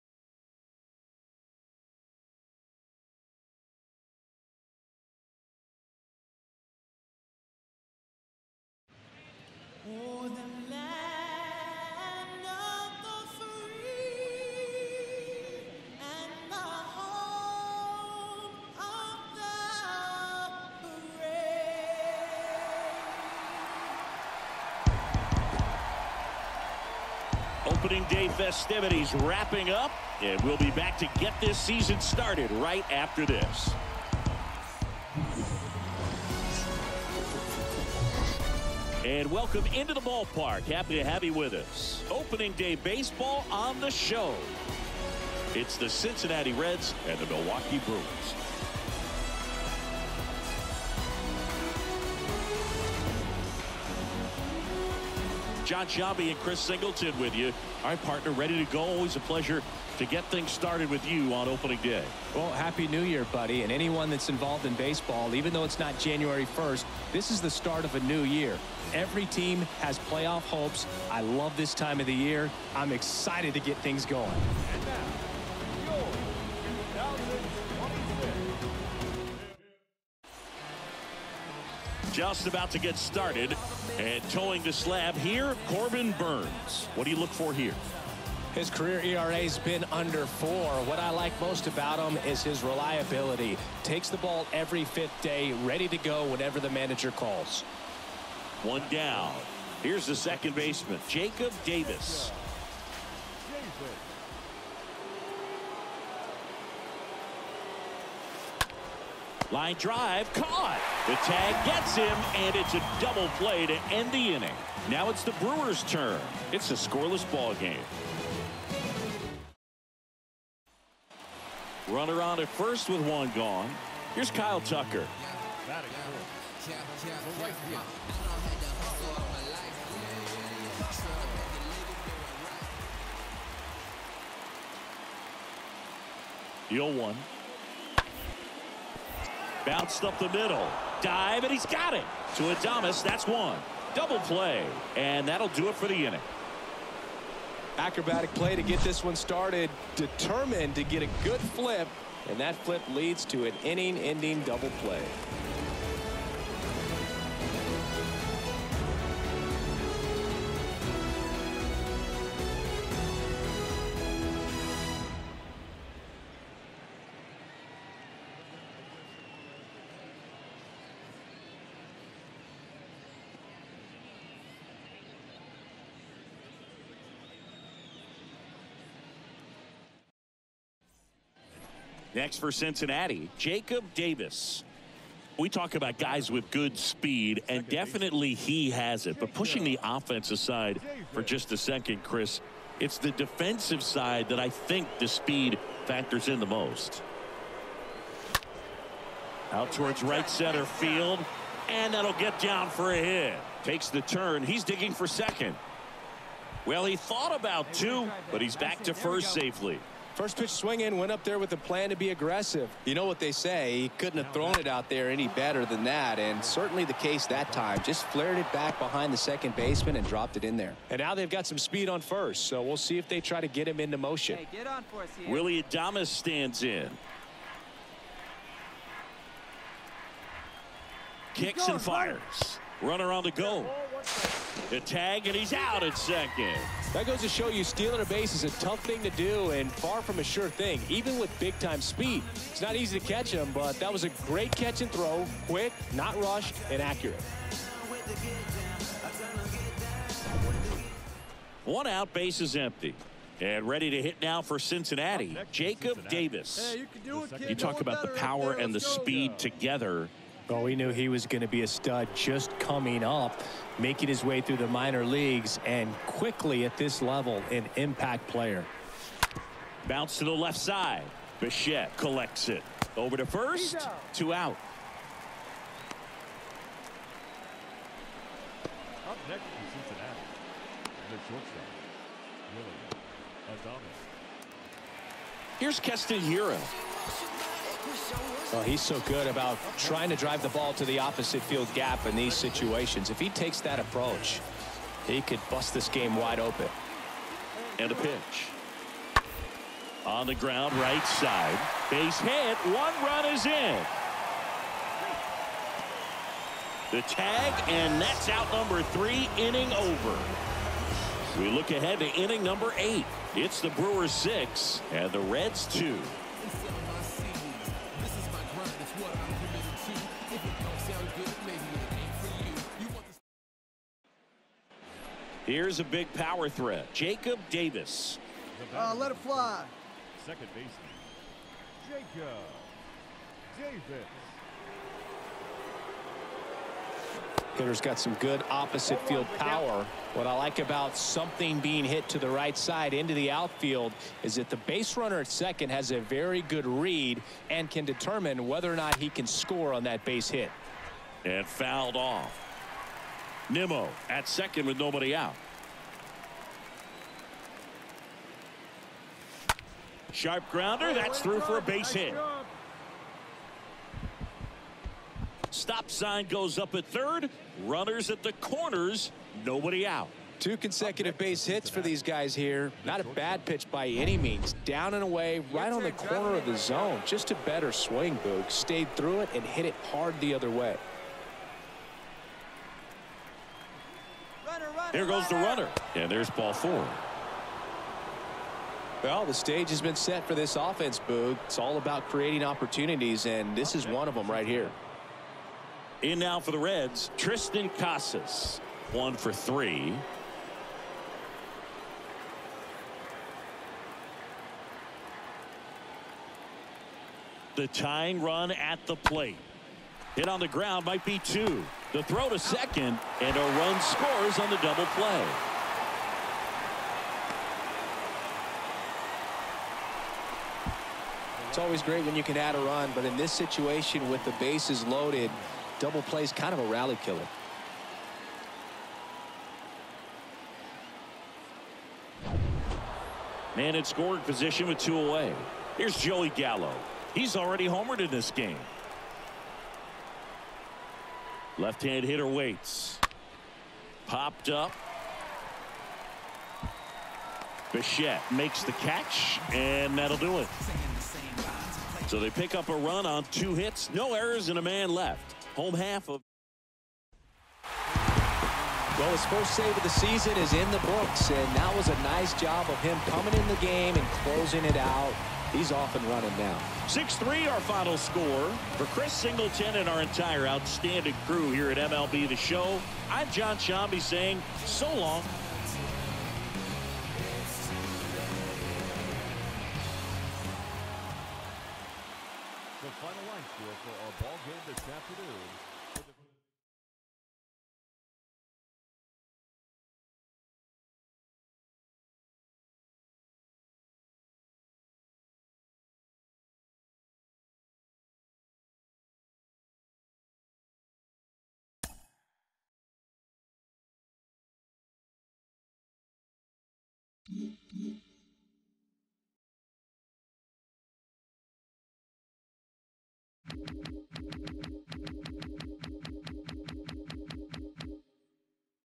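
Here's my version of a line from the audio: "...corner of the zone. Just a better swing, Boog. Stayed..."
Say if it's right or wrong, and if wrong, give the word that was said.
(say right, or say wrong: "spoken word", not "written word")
right.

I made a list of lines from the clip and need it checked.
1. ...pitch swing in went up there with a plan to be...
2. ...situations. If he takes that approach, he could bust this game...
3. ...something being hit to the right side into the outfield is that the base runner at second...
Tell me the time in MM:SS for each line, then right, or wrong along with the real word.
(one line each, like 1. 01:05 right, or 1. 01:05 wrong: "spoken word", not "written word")
1. 03:30 right
2. 04:52 right
3. 05:40 right.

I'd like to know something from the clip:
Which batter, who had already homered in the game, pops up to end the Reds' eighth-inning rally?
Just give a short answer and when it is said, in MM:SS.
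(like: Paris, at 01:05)
Joey Gallo, at 07:15.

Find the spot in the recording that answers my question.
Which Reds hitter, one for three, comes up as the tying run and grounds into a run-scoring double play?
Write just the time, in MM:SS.
06:37.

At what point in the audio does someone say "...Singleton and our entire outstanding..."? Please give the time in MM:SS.
07:49.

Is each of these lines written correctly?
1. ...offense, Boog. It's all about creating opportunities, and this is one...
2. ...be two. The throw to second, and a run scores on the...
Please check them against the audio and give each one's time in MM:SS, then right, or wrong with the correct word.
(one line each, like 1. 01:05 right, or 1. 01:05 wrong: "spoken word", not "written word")
1. 06:30 right
2. 06:51 right.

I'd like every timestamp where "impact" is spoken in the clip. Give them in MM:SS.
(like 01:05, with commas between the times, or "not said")
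04:27.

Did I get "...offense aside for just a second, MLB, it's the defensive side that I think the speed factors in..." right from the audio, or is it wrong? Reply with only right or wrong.
wrong.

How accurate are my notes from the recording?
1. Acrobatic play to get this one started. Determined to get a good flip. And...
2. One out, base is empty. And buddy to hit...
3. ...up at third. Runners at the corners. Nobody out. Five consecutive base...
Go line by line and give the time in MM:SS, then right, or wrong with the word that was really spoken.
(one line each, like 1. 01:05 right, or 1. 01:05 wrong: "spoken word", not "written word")
1. 02:27 right
2. 04:11 wrong: "ready", not "buddy"
3. 06:06 wrong: "Two", not "Five".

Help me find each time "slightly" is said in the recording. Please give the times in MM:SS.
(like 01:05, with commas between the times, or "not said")
not said.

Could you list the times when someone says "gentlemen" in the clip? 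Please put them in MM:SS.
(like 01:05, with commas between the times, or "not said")
not said.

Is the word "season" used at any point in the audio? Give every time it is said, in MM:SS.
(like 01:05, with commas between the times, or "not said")
00:31, 07:39.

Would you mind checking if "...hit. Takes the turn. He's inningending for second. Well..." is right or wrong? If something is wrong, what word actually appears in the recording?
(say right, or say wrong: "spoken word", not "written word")
wrong: "digging", not "inningending".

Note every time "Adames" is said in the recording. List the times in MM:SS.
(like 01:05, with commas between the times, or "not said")
02:22, 03:45.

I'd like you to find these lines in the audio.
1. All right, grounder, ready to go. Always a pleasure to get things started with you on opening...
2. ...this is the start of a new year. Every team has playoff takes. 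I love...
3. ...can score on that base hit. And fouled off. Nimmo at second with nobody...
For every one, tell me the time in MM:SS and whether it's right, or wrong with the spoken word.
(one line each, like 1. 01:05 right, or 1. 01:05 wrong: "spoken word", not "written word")
1. 00:57 wrong: "partner", not "grounder"
2. 01:07 wrong: "hopes", not "takes"
3. 05:49 right.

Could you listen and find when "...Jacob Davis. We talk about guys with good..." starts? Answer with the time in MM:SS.
03:03.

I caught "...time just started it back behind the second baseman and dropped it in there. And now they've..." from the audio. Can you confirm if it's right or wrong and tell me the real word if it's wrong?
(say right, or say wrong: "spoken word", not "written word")
wrong: "flared", not "started".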